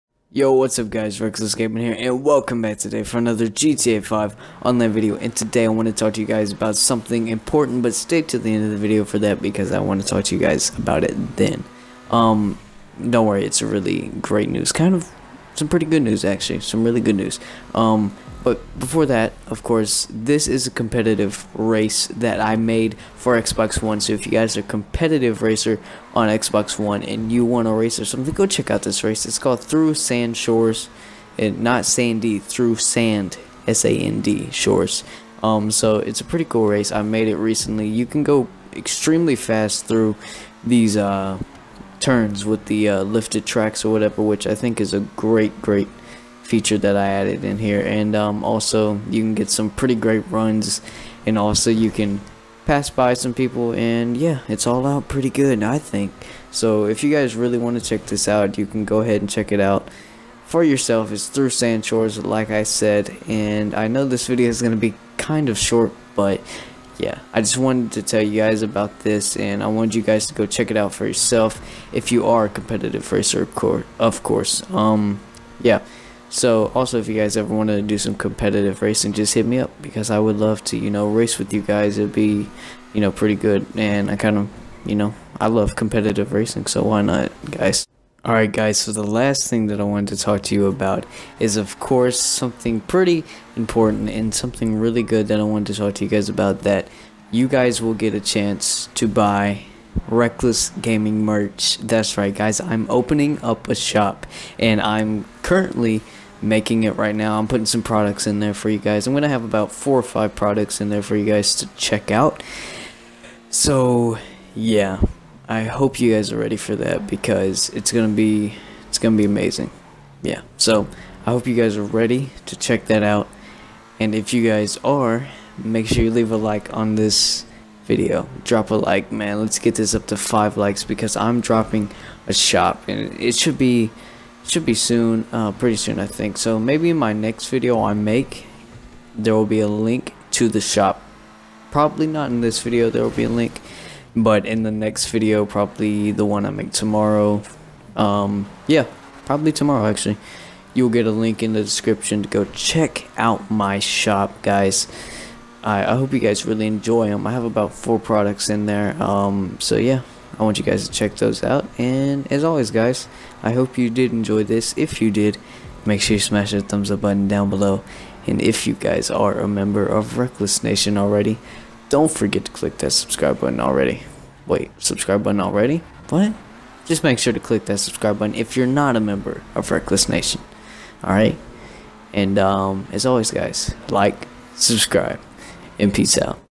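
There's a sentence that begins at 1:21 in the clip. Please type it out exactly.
It'd be, you know, pretty good.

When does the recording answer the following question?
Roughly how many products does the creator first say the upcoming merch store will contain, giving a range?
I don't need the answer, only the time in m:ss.
1:49.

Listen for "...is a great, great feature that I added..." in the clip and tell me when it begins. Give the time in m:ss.
0:44.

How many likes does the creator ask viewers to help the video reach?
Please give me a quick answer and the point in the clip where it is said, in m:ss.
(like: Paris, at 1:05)
5, at 2:10.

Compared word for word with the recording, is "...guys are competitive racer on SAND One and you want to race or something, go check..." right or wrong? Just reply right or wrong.
wrong.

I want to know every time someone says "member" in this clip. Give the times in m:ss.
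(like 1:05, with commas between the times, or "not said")
2:49, 2:58.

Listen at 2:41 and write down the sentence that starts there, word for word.
And as always, guys, I hope you did enjoy this.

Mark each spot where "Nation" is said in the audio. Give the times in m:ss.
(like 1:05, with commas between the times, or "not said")
2:50, 3:00.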